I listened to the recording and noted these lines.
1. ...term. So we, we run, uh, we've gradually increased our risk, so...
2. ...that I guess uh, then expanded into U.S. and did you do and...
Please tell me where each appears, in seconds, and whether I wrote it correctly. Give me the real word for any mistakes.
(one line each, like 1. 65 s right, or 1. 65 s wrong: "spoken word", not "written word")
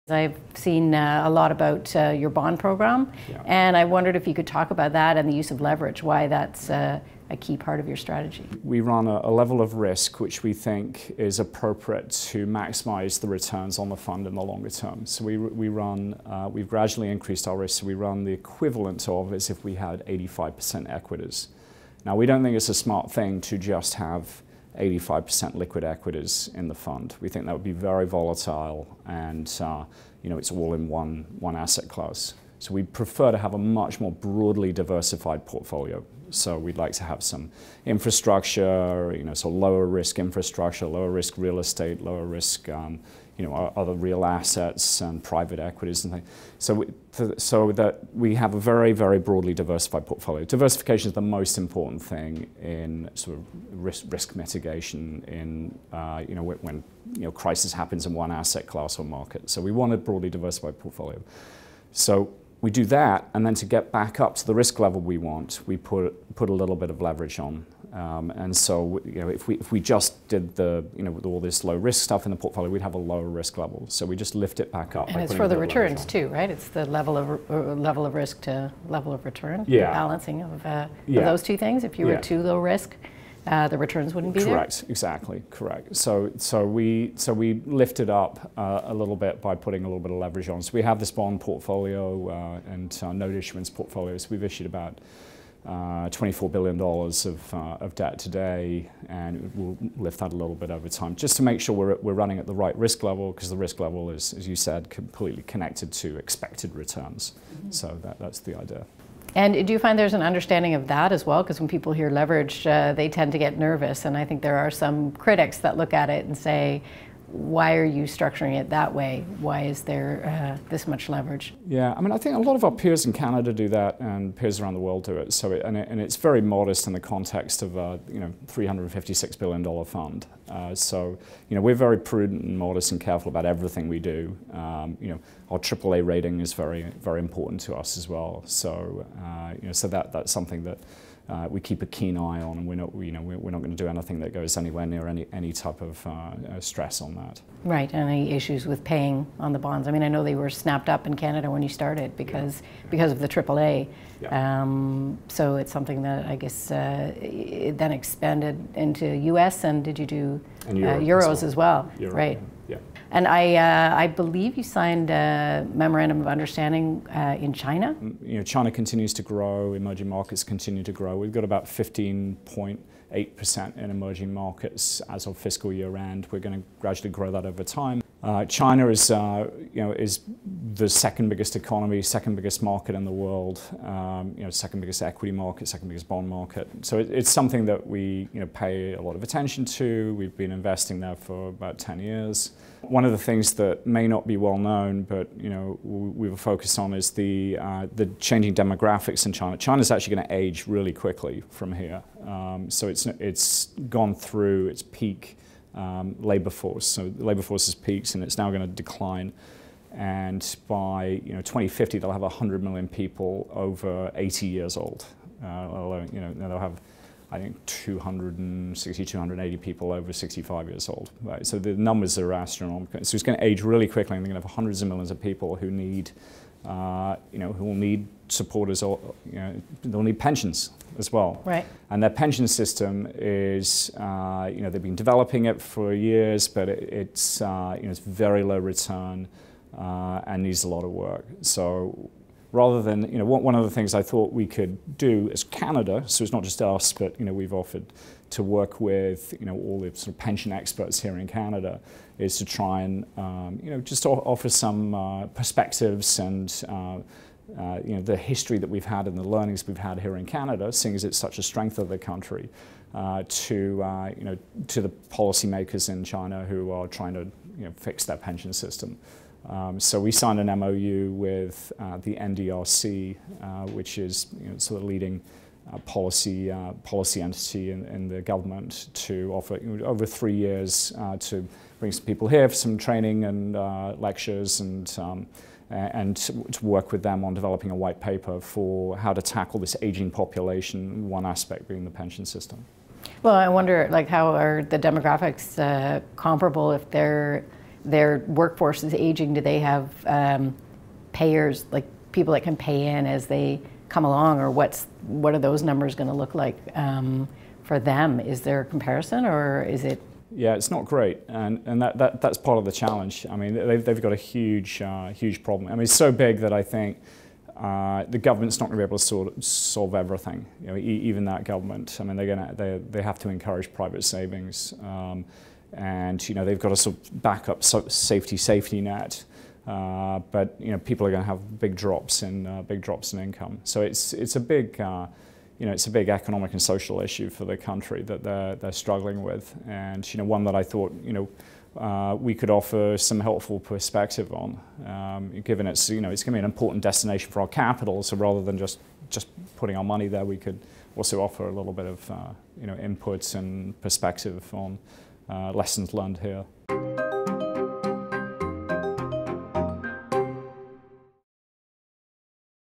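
1. 14 s right
2. 156 s right.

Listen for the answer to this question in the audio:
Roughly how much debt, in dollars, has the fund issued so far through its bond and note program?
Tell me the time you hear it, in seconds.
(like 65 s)
96 s.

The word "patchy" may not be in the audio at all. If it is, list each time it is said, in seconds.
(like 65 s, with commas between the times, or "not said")
not said.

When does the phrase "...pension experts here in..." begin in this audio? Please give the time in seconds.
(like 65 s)
250 s.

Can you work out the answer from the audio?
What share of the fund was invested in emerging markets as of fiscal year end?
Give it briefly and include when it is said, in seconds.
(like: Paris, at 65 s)
15.8%, at 171 s.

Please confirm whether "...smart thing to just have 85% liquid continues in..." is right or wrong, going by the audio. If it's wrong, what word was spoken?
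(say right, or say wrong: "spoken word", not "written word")
wrong: "equities", not "continues".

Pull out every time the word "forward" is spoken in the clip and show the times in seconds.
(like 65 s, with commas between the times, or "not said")
not said.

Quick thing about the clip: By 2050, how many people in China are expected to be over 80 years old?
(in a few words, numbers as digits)
100 million.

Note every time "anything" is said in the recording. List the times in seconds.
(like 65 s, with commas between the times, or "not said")
143 s.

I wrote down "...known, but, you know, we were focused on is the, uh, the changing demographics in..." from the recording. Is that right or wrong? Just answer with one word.
right.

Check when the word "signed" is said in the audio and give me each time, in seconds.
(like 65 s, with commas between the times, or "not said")
164 s, 270 s.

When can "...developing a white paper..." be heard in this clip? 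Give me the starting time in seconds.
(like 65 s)
287 s.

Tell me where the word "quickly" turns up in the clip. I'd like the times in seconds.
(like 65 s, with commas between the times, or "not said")
200 s, 223 s.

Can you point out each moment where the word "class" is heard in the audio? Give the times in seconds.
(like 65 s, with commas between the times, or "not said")
31 s, 58 s.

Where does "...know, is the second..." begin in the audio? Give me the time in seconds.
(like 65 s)
179 s.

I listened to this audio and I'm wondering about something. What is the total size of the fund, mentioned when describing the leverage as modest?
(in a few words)
$356 billion.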